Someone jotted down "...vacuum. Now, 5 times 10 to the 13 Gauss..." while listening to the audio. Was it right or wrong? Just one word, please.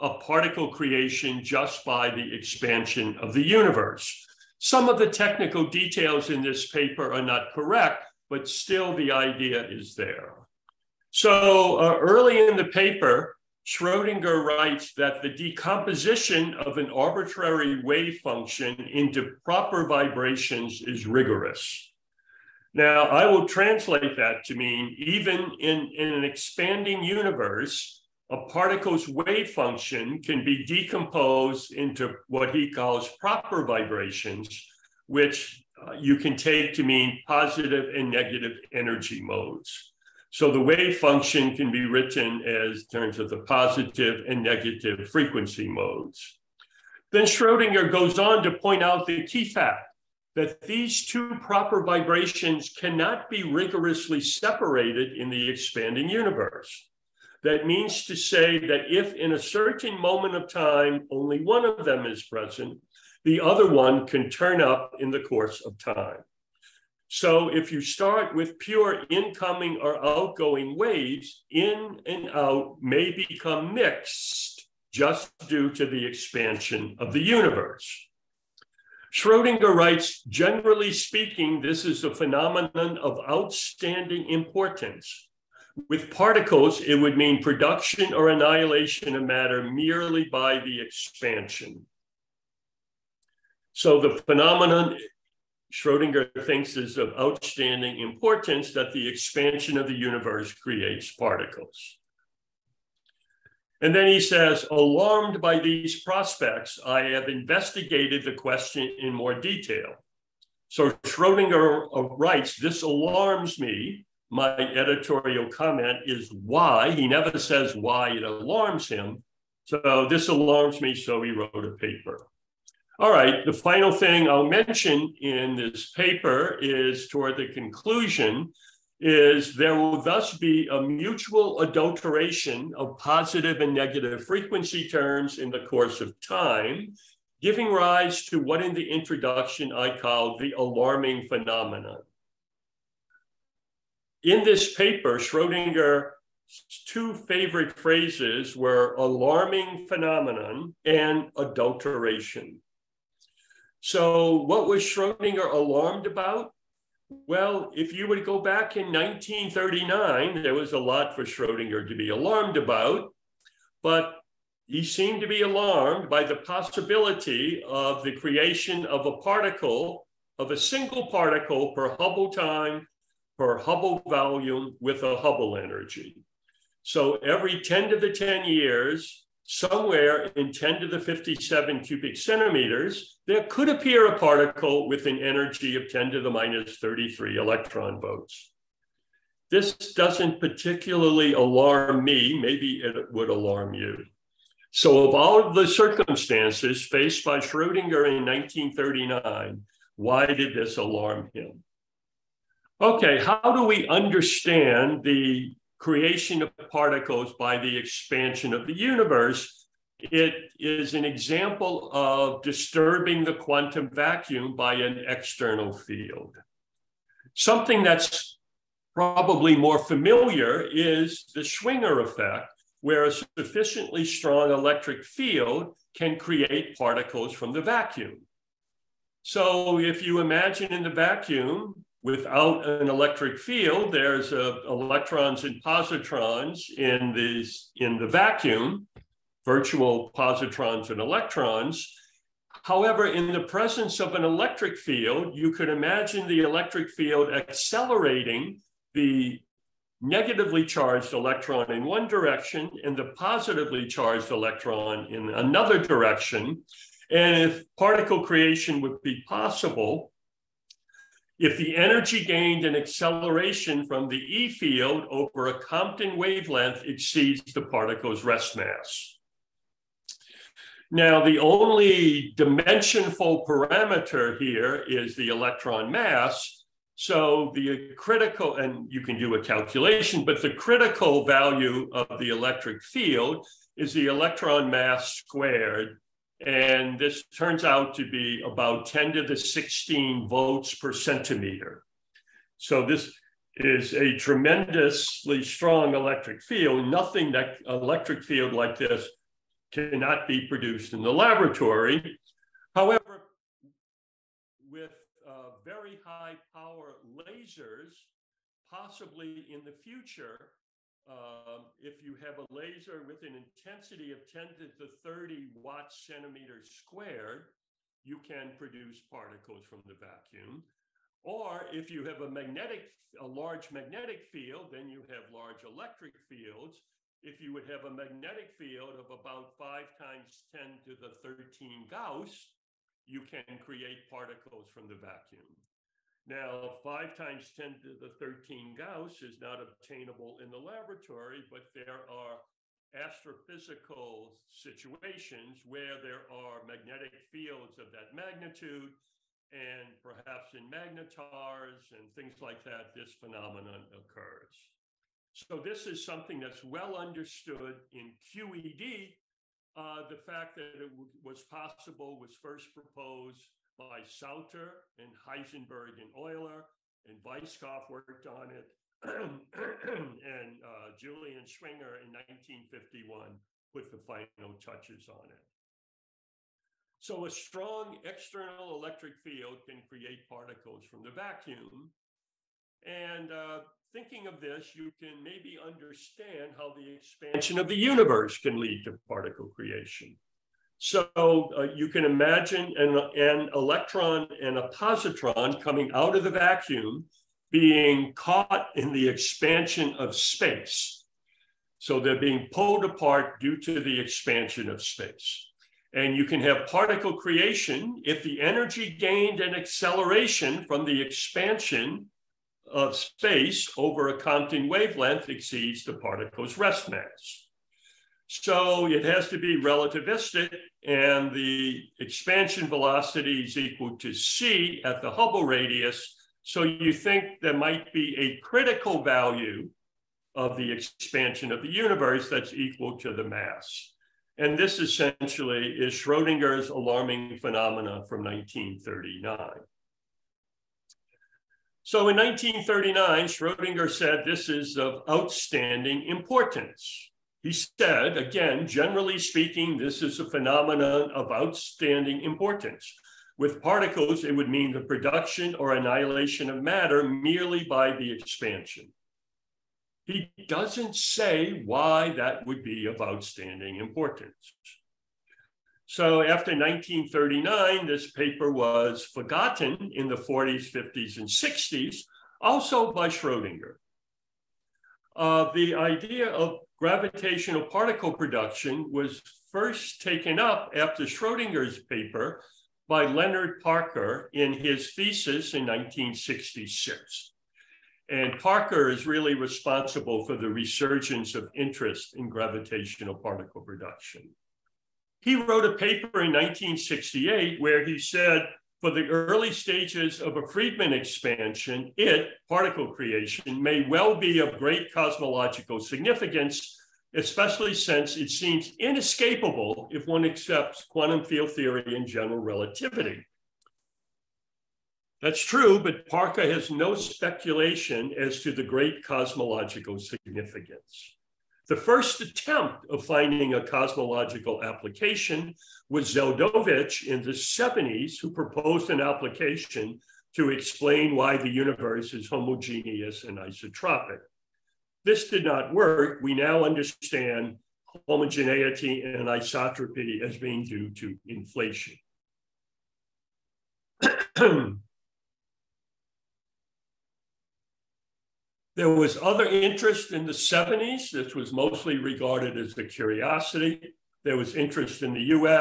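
right.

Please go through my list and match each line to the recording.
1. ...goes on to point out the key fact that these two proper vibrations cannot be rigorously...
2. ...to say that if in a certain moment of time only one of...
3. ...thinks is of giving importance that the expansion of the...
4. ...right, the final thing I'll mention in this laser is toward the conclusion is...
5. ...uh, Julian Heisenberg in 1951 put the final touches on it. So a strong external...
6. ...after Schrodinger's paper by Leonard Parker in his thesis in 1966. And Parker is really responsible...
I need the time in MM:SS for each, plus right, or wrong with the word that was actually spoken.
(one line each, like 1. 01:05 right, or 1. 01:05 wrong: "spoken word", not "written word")
1. 00:47 right
2. 00:58 right
3. 01:36 wrong: "outstanding", not "giving"
4. 02:03 wrong: "paper", not "laser"
5. 06:10 wrong: "Schwinger", not "Heisenberg"
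6. 08:00 right.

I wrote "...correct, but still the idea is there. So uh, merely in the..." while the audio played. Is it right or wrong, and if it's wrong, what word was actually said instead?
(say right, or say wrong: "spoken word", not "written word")
wrong: "early", not "merely".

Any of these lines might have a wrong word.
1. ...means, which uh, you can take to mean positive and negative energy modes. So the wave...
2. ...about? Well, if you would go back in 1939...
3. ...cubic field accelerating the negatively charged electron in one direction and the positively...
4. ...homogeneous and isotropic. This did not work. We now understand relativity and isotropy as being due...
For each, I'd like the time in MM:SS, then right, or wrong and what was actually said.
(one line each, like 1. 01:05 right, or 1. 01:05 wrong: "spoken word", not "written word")
1. 00:33 wrong: "vibrations", not "means"
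2. 02:36 right
3. 04:06 wrong: "electric", not "cubic"
4. 08:52 wrong: "homogeneity", not "relativity".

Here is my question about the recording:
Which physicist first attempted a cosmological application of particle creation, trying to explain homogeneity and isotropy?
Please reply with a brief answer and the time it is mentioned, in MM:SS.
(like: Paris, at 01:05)
Zeldovich, at 08:46.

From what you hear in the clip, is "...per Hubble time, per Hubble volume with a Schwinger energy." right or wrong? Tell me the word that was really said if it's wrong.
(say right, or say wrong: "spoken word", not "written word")
wrong: "Hubble", not "Schwinger".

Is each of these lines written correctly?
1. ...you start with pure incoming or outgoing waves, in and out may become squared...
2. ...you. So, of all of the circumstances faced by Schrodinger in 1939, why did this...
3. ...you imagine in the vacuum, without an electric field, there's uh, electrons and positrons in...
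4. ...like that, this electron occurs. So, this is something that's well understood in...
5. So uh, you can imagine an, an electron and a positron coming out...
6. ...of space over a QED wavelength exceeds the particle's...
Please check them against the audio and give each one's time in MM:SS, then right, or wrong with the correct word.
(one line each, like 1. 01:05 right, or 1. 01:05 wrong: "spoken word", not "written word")
1. 01:07 wrong: "mixed", not "squared"
2. 03:13 right
3. 03:50 right
4. 05:52 wrong: "phenomenon", not "electron"
5. 06:30 right
6. 06:52 wrong: "Compton", not "QED".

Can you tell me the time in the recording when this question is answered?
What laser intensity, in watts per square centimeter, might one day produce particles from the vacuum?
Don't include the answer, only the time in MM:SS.
05:14.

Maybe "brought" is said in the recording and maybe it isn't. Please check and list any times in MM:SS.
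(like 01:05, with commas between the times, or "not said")
not said.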